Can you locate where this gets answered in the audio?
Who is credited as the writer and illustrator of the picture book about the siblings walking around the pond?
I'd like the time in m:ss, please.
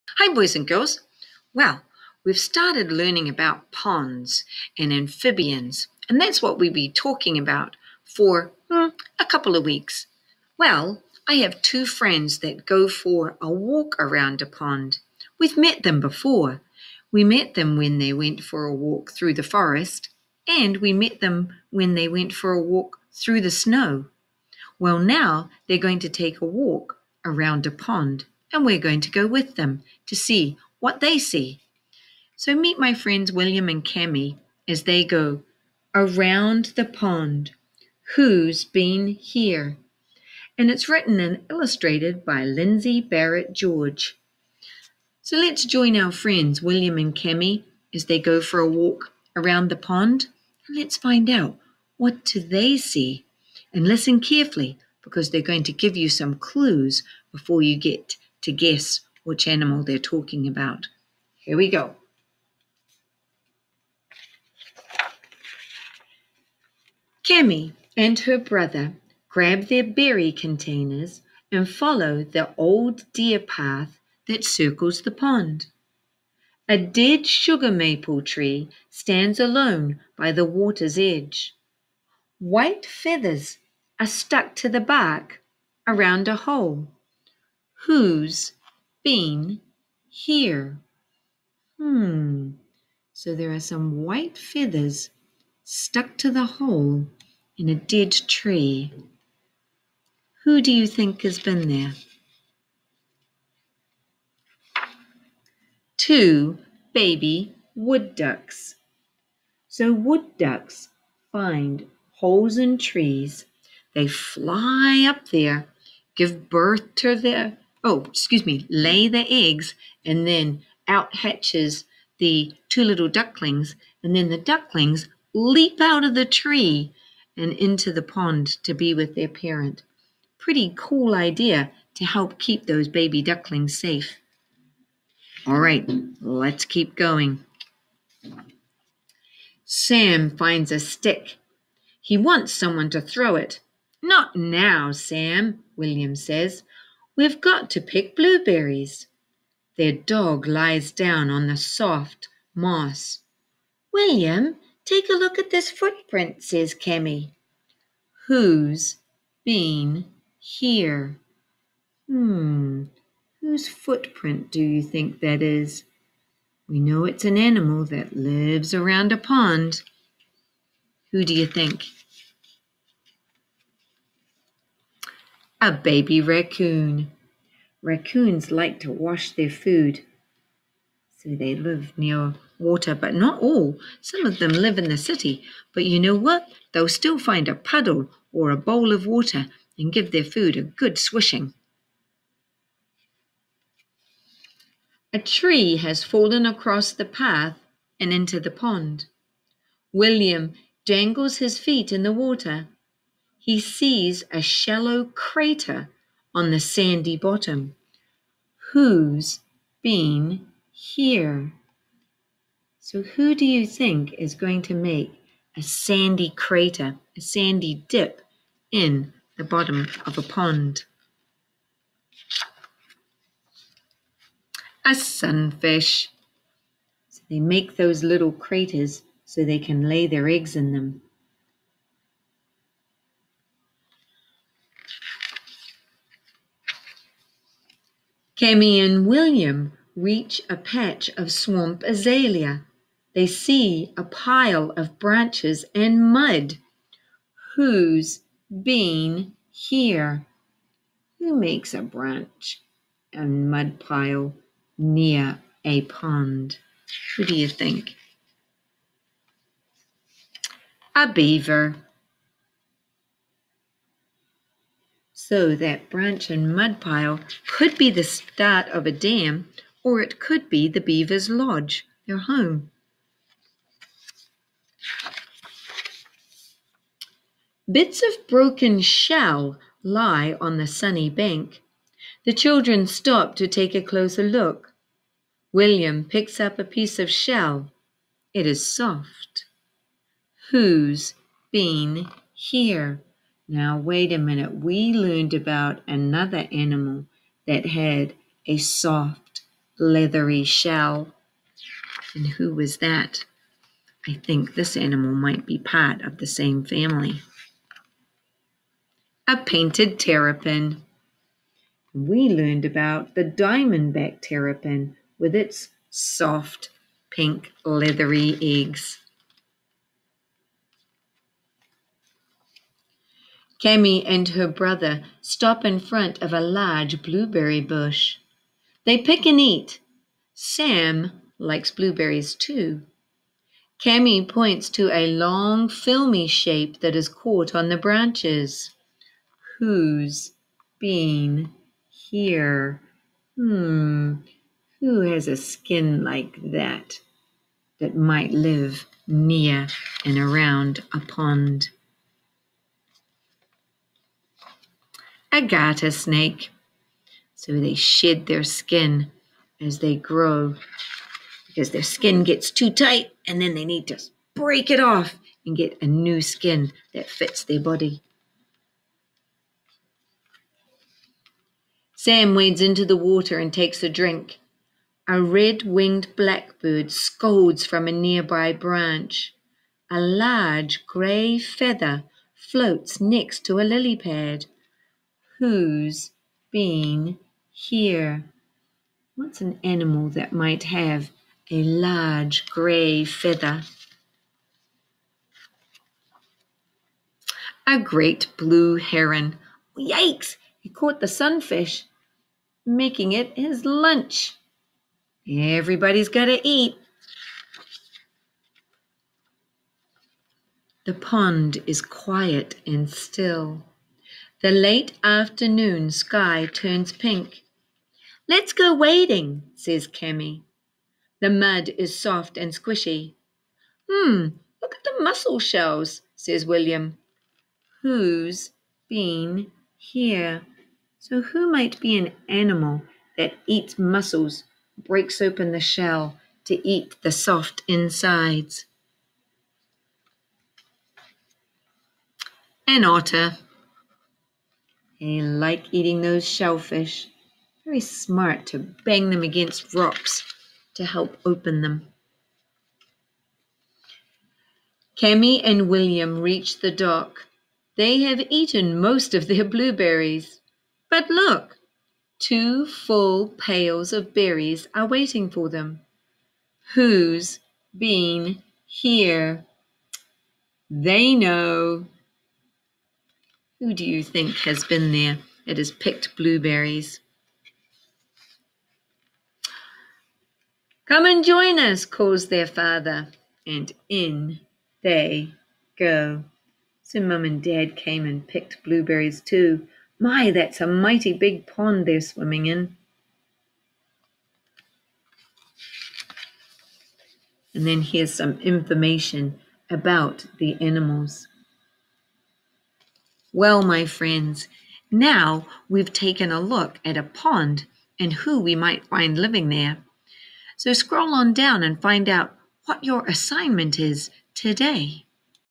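0:42.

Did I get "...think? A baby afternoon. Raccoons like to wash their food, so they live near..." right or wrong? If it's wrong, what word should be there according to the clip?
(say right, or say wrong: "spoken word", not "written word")
wrong: "raccoon", not "afternoon".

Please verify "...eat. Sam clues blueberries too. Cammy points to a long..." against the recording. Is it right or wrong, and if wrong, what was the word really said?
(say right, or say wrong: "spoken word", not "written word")
wrong: "likes", not "clues".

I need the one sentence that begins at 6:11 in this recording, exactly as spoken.
Sam wades into the water and takes a drink.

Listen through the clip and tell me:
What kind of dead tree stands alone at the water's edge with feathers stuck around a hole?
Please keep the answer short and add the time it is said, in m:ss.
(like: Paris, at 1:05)
Sugar maple, at 1:17.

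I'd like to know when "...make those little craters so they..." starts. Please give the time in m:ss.
3:47.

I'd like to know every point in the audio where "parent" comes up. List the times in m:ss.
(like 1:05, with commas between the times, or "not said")
2:09.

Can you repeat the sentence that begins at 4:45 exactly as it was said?
William picks up a piece of shell.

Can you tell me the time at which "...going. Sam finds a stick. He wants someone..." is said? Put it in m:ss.
2:16.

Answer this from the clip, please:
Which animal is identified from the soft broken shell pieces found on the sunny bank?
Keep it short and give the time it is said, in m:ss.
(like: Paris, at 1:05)
Painted terrapin, at 5:09.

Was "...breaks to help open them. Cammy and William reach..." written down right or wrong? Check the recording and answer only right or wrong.
wrong.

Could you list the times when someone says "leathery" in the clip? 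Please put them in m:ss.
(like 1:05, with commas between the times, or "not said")
4:59, 5:17.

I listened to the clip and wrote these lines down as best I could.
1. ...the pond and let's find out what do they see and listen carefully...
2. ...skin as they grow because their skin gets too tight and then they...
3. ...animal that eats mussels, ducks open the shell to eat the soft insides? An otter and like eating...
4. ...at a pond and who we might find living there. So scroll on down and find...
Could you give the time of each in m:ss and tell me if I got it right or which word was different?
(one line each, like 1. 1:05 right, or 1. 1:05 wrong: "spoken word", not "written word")
1. 0:49 right
2. 5:58 right
3. 7:12 wrong: "breaks", not "ducks"
4. 8:26 right.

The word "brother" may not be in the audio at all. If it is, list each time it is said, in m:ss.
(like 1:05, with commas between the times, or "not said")
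1:08, 5:24.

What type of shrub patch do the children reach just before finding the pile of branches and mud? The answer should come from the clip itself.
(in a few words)
Swamp azalea.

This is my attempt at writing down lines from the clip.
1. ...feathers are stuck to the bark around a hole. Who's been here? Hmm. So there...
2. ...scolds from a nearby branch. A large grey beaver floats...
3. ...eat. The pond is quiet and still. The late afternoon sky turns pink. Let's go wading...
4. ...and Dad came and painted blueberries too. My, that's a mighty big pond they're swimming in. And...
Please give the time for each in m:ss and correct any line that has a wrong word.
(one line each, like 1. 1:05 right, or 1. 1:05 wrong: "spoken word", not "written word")
1. 1:22 right
2. 6:16 wrong: "feather", not "beaver"
3. 6:46 right
4. 8:07 wrong: "picked", not "painted".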